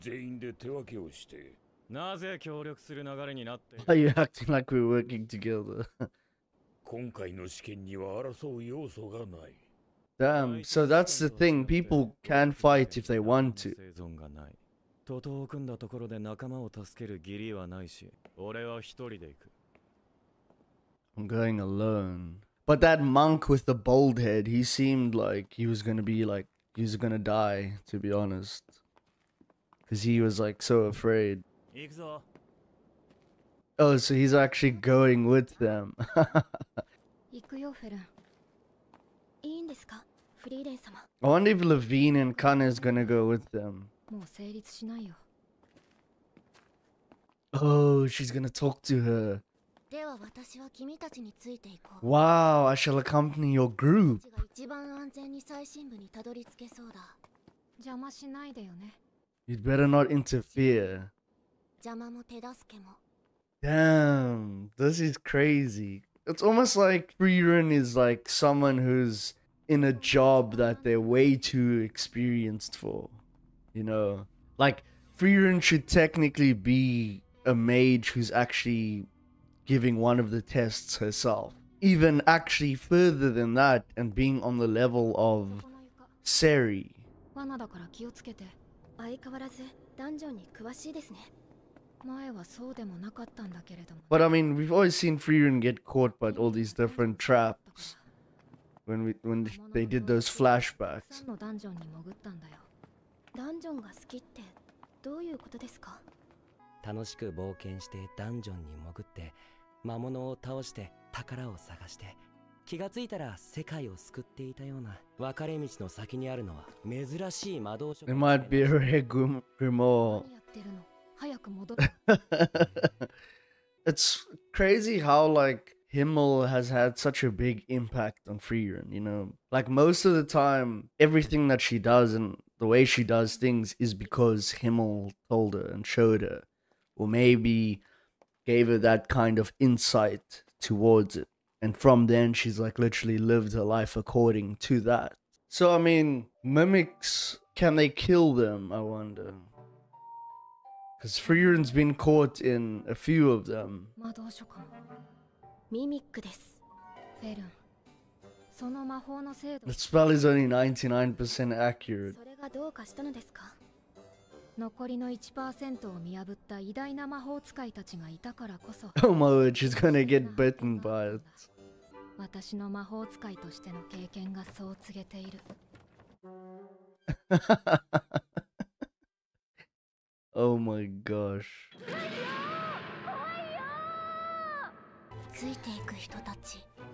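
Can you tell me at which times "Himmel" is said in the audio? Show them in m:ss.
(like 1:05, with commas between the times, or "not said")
2:05, 2:14.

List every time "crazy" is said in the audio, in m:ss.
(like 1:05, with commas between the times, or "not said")
1:05, 2:04.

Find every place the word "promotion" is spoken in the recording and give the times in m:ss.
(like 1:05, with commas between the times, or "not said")
not said.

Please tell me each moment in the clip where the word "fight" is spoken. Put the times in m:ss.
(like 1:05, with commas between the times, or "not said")
0:12.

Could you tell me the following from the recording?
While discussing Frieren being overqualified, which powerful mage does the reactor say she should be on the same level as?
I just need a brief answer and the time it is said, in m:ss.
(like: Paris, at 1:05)
Serie, at 1:26.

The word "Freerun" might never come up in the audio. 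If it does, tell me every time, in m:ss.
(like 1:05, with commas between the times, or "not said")
2:08.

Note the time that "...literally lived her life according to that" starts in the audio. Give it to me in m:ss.
2:22.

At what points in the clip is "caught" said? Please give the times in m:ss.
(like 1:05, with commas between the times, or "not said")
1:35, 2:31.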